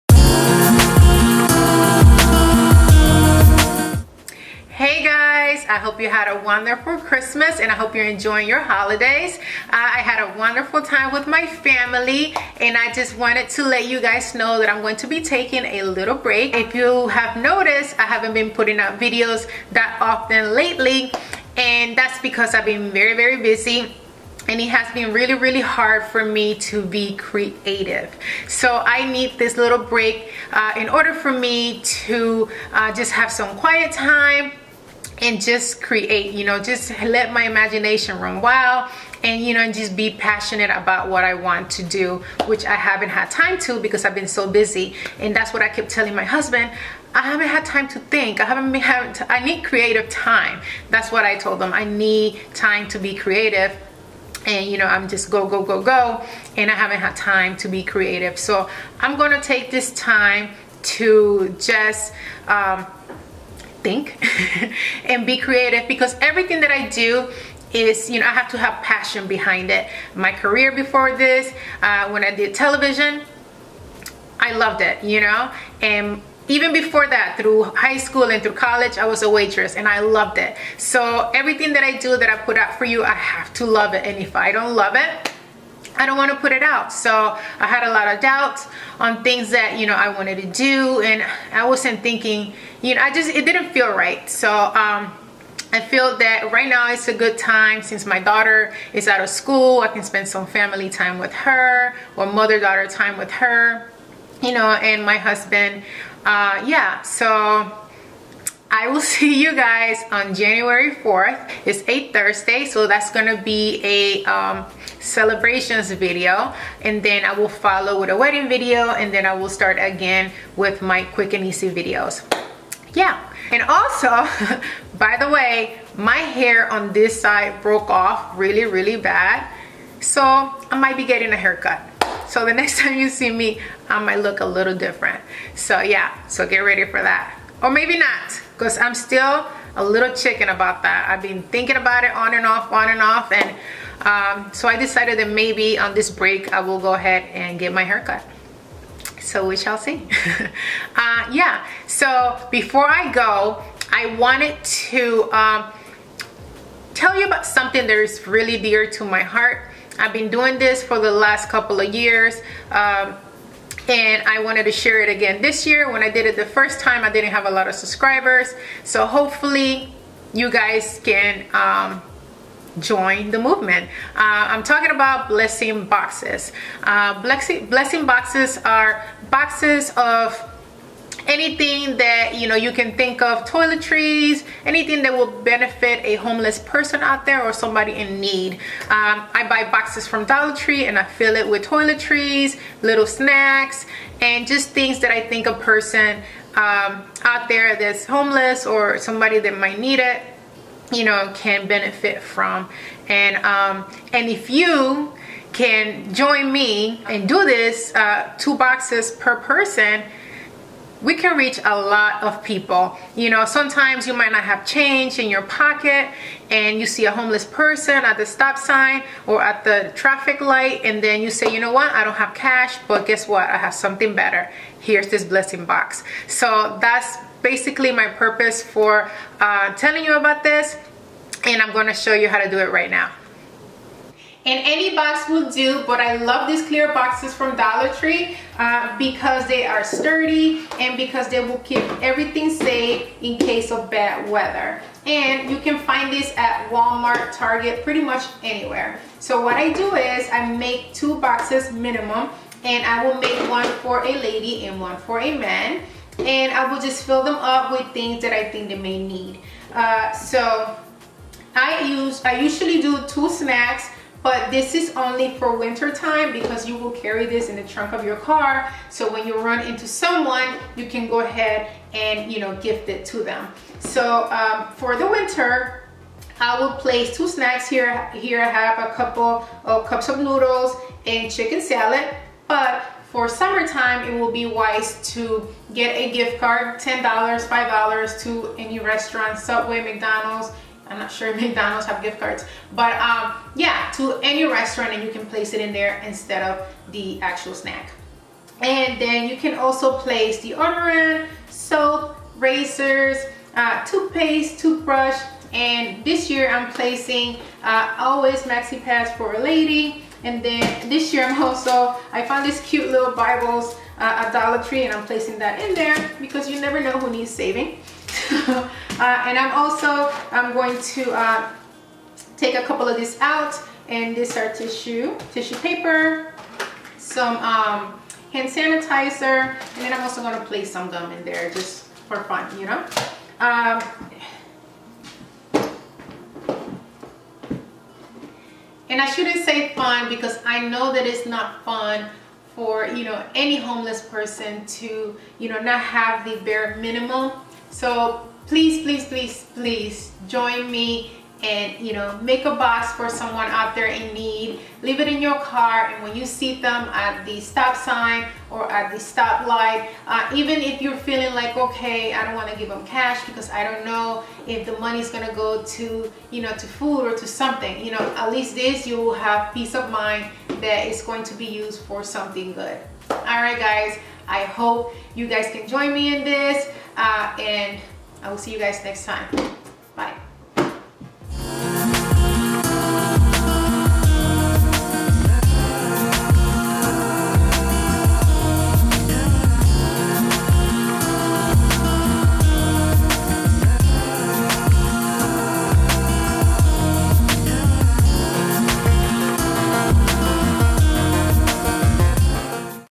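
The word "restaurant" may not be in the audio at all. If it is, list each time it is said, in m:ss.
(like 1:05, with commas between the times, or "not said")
4:48, 4:54.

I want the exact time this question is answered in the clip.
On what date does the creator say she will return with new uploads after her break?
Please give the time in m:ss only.
1:50.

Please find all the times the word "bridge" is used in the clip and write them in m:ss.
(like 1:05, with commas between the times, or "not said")
not said.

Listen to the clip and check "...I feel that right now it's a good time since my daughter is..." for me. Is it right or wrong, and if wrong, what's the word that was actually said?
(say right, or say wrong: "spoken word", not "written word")
right.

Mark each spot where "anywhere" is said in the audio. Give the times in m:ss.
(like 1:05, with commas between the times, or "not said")
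4:08.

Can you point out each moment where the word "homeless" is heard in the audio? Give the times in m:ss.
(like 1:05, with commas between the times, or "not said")
3:06, 3:18, 3:37, 5:43.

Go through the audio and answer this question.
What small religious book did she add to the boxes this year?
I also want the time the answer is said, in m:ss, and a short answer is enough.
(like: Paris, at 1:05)
Bibles, at 5:13.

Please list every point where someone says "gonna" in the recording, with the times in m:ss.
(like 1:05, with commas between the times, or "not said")
0:59, 1:53, 3:51, 6:05.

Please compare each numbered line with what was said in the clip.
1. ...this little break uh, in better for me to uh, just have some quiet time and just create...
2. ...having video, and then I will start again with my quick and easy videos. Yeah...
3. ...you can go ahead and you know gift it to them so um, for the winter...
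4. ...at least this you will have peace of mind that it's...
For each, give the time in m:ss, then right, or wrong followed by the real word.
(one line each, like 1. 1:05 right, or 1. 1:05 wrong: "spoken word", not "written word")
1. 0:29 wrong: "order", not "better"
2. 1:58 wrong: "wedding", not "having"
3. 4:30 right
4. 6:08 right.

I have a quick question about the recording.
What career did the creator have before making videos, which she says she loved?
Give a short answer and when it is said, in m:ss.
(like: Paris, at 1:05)
Television, at 1:12.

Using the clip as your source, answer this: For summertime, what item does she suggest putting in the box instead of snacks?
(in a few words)
Gift card.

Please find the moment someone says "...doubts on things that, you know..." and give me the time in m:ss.
1:28.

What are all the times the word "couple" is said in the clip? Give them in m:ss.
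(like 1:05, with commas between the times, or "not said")
2:41, 4:38, 5:22.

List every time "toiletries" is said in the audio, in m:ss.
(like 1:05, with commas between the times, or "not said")
3:03, 3:11.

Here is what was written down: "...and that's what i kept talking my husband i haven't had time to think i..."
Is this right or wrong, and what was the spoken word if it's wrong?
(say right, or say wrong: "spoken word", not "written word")
wrong: "telling", not "talking".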